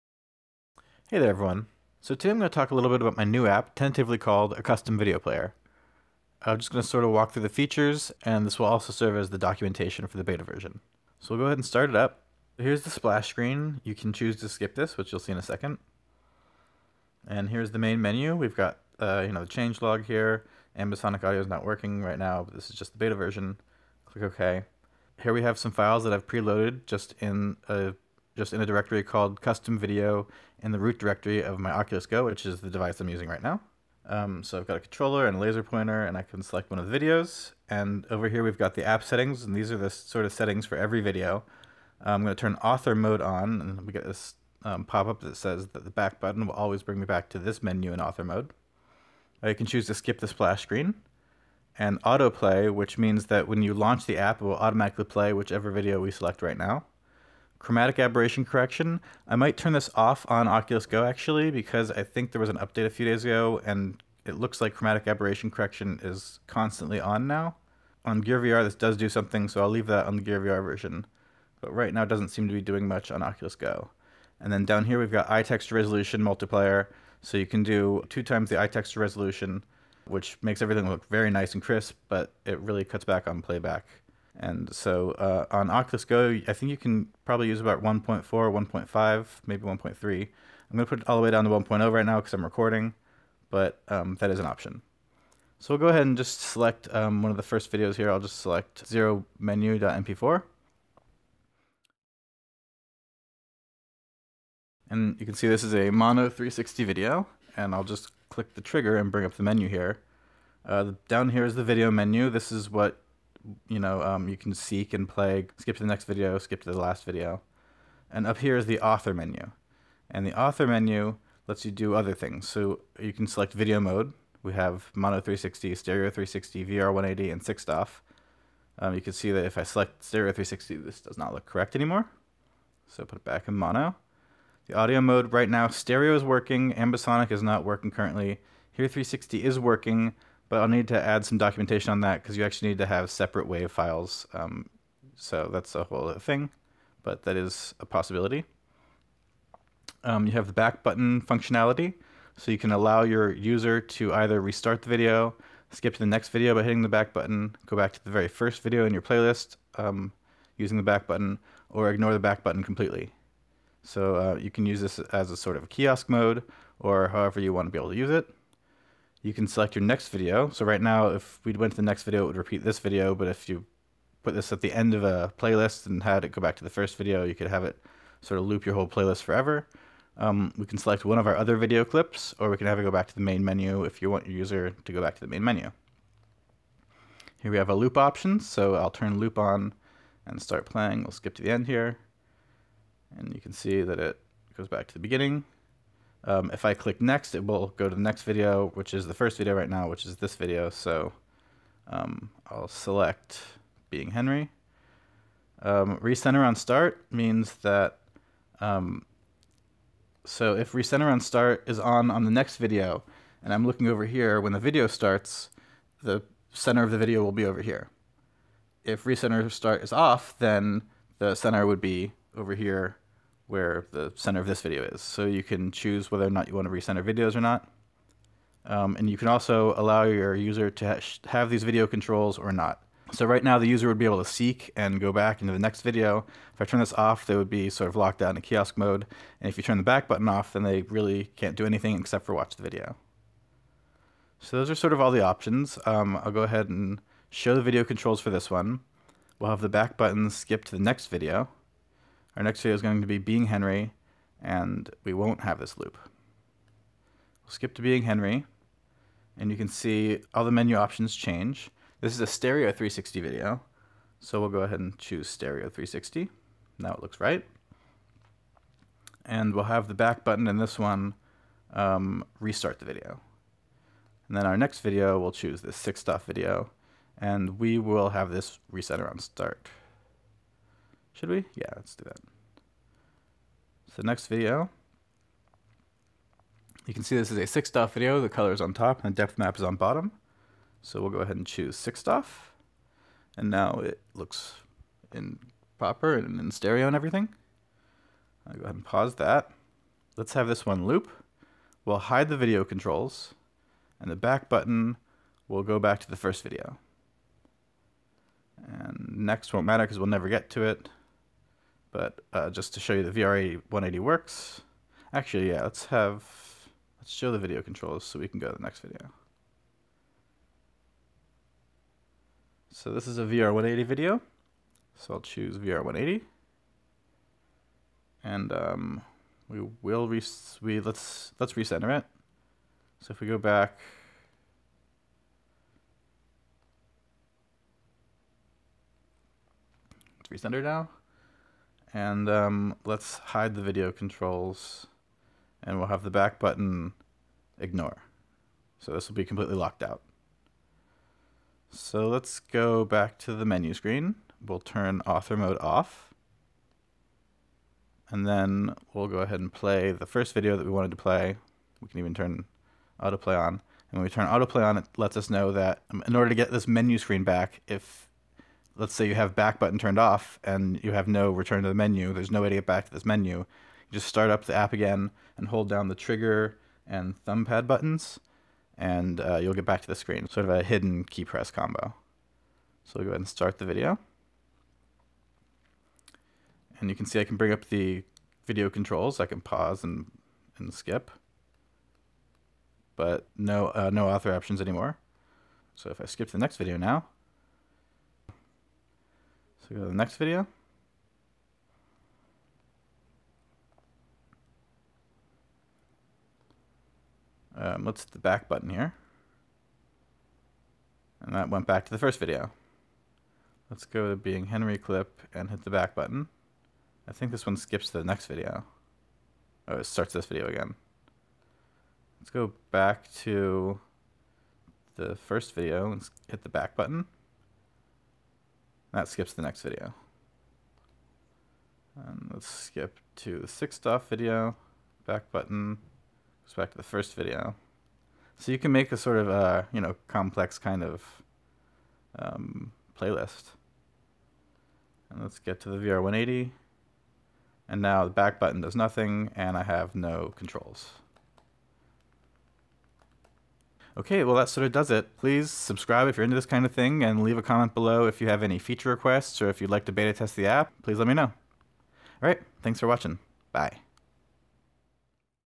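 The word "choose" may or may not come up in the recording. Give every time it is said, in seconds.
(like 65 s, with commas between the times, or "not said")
14 s, 49 s, 225 s, 264 s, 275 s, 291 s, 325 s.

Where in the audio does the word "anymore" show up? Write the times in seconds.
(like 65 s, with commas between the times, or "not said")
131 s, 394 s.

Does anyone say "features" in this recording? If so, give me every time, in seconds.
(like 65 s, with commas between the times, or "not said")
7 s, 458 s.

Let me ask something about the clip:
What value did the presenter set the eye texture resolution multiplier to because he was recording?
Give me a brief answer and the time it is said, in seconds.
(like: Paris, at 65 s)
1.0, at 91 s.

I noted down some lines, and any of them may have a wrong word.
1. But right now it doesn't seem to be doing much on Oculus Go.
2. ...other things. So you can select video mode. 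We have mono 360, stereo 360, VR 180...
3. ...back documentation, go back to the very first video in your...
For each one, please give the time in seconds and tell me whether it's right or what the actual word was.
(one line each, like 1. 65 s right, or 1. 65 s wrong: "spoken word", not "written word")
1. 71 s right
2. 121 s right
3. 156 s wrong: "button", not "documentation".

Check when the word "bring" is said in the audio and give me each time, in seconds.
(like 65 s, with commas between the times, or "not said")
46 s, 109 s, 387 s.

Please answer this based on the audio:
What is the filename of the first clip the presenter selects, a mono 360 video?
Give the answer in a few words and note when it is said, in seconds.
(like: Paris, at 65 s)
0 menu.mp4, at 98 s.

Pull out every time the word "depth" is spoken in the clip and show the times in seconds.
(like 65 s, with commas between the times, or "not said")
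289 s.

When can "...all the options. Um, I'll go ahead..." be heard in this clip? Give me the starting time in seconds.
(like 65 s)
245 s.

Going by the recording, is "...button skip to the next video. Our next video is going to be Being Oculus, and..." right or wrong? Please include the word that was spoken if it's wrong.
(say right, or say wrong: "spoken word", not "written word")
wrong: "Henry", not "Oculus".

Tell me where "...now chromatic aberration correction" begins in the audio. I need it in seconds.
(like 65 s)
56 s.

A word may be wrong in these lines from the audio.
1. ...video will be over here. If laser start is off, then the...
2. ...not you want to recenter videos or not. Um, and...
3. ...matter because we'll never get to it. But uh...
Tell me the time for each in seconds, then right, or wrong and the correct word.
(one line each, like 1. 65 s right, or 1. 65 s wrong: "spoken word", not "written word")
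1. 216 s wrong: "recenter", not "laser"
2. 226 s right
3. 309 s right.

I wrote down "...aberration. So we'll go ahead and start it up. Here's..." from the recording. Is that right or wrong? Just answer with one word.
wrong.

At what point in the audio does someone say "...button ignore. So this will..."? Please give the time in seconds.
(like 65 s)
346 s.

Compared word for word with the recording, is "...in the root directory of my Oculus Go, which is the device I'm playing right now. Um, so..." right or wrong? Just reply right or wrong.
wrong.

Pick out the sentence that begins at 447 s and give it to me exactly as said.
And now the back button does nothing, and I have no controls.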